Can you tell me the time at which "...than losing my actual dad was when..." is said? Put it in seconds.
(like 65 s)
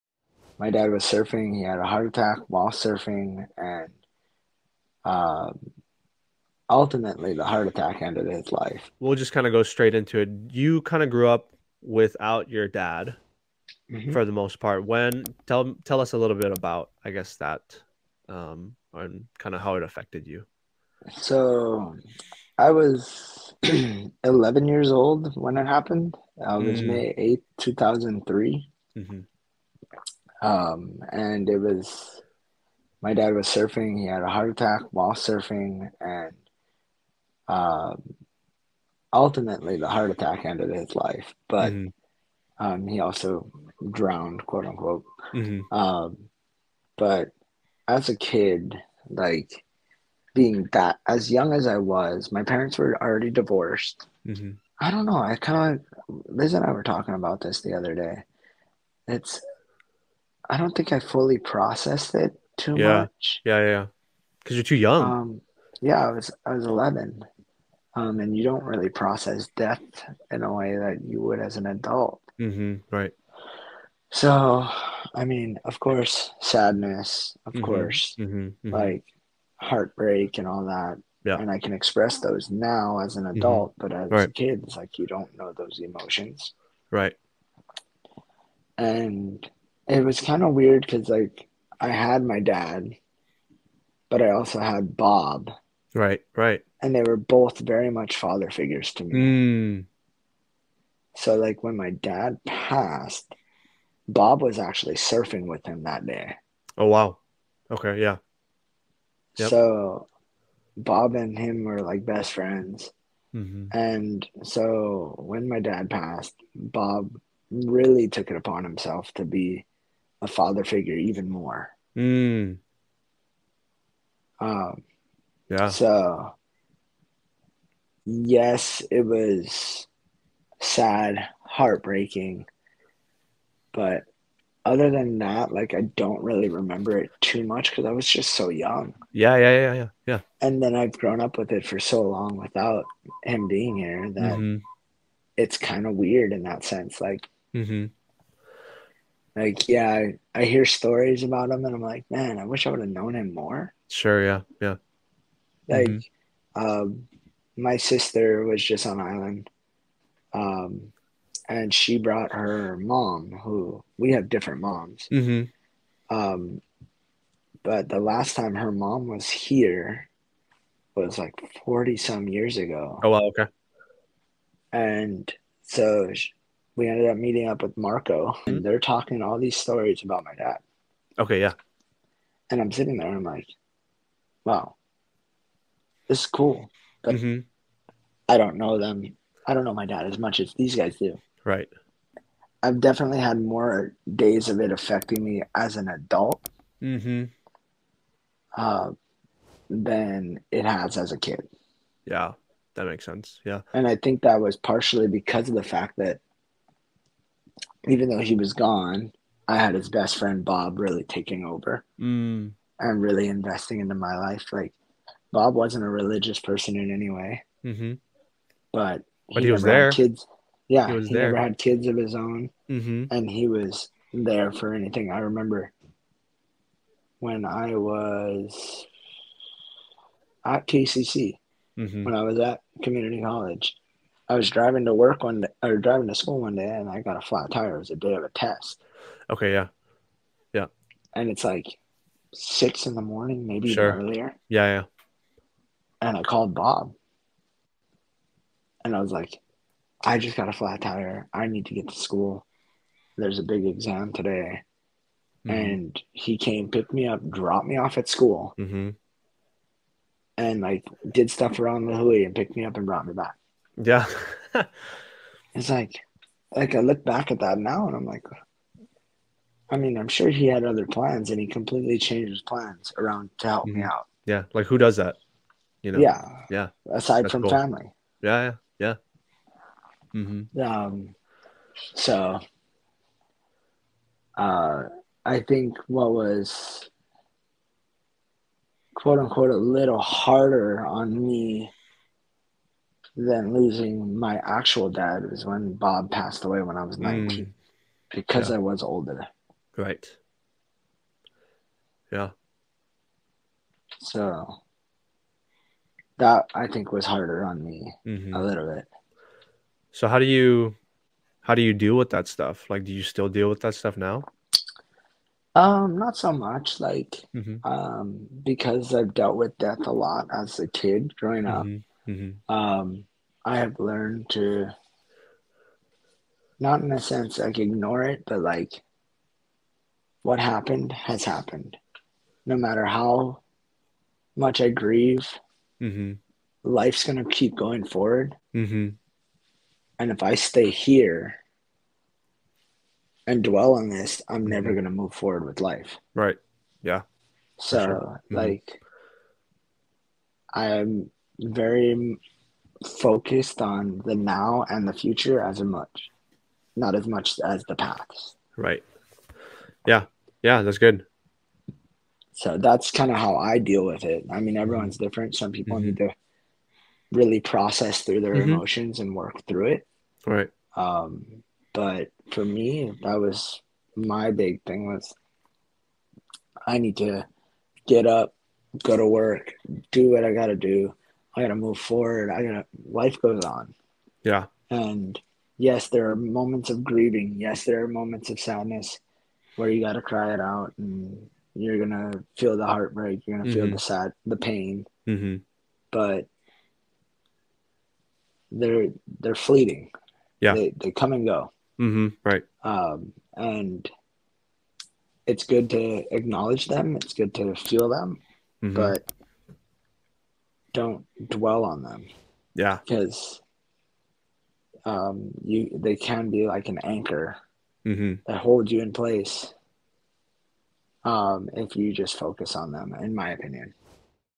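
293 s.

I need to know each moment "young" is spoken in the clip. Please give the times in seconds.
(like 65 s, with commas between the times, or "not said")
51 s, 64 s, 138 s.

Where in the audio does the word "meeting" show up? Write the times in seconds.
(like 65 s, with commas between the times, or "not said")
177 s.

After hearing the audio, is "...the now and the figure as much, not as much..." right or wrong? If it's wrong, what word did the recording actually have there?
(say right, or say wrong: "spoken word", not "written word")
wrong: "future", not "figure".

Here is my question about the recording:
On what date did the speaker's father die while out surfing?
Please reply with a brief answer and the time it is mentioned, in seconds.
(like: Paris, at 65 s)
May 8, 2003, at 26 s.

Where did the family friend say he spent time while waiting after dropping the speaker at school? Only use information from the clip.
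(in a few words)
the Hui.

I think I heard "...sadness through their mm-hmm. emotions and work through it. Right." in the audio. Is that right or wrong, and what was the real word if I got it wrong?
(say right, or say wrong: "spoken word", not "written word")
wrong: "process", not "sadness".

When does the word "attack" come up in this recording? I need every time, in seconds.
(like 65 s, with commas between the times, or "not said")
2 s, 7 s, 34 s, 40 s.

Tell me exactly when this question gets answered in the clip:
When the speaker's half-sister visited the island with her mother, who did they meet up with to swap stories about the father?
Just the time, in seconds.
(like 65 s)
177 s.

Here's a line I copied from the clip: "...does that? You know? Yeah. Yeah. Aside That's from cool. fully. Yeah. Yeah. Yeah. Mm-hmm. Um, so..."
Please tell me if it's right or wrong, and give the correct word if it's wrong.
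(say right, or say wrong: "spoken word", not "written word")
wrong: "family", not "fully".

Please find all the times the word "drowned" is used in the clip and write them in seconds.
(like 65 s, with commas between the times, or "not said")
43 s.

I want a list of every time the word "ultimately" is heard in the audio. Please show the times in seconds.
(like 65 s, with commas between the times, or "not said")
6 s, 39 s.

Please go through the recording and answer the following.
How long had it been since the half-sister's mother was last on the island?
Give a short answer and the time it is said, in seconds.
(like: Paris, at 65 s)
40 some years, at 171 s.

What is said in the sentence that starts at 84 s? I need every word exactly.
kids, like you don't know those emotions.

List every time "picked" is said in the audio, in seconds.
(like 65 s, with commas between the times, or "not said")
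256 s, 262 s.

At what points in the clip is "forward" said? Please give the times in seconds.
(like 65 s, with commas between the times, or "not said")
337 s, 345 s, 381 s.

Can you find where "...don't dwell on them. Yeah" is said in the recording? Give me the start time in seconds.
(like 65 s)
410 s.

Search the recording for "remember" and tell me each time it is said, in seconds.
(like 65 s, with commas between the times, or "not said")
136 s, 225 s.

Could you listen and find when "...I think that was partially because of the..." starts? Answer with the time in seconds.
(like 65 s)
203 s.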